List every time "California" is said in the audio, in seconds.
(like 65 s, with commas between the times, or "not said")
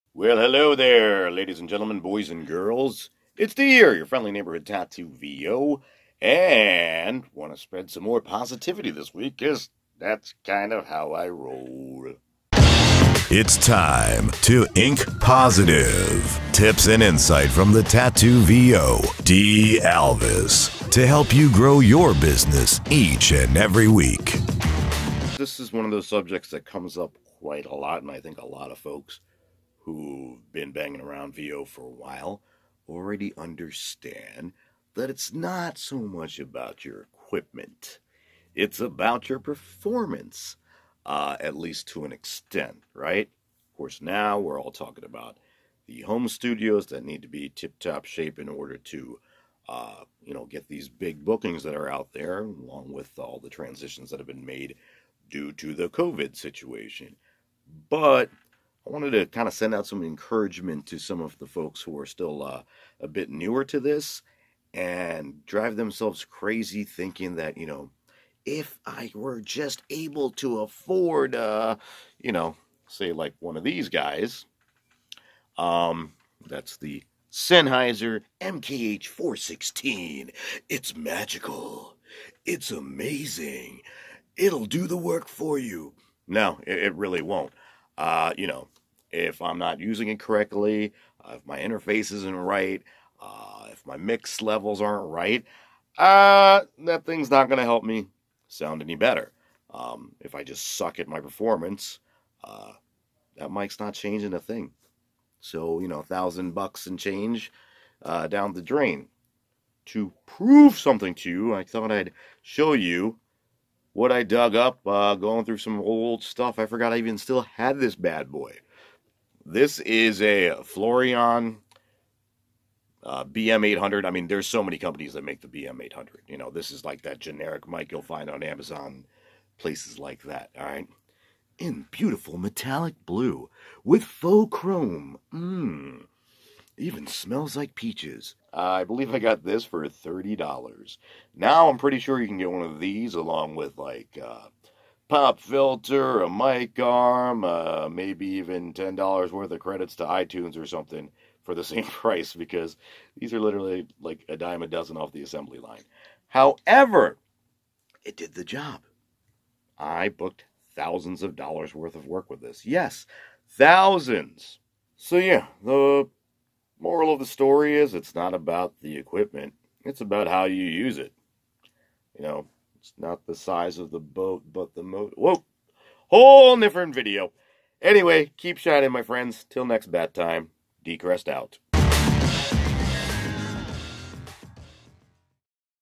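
not said.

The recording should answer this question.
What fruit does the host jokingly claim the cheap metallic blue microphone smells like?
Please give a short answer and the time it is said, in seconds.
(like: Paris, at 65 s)
peaches, at 137 s.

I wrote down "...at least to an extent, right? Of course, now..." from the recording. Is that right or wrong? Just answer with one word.
right.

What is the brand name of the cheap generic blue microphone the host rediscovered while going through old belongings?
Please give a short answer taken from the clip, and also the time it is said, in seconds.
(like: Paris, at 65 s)
Floureon, at 120 s.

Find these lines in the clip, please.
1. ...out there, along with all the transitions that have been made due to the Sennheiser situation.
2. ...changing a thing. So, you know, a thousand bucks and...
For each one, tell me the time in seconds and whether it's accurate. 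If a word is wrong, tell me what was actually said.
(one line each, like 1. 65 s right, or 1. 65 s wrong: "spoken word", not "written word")
1. 51 s wrong: "COVID", not "Sennheiser"
2. 103 s right.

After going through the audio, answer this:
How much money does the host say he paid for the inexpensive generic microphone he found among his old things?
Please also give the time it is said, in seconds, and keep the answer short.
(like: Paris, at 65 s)
$30, at 139 s.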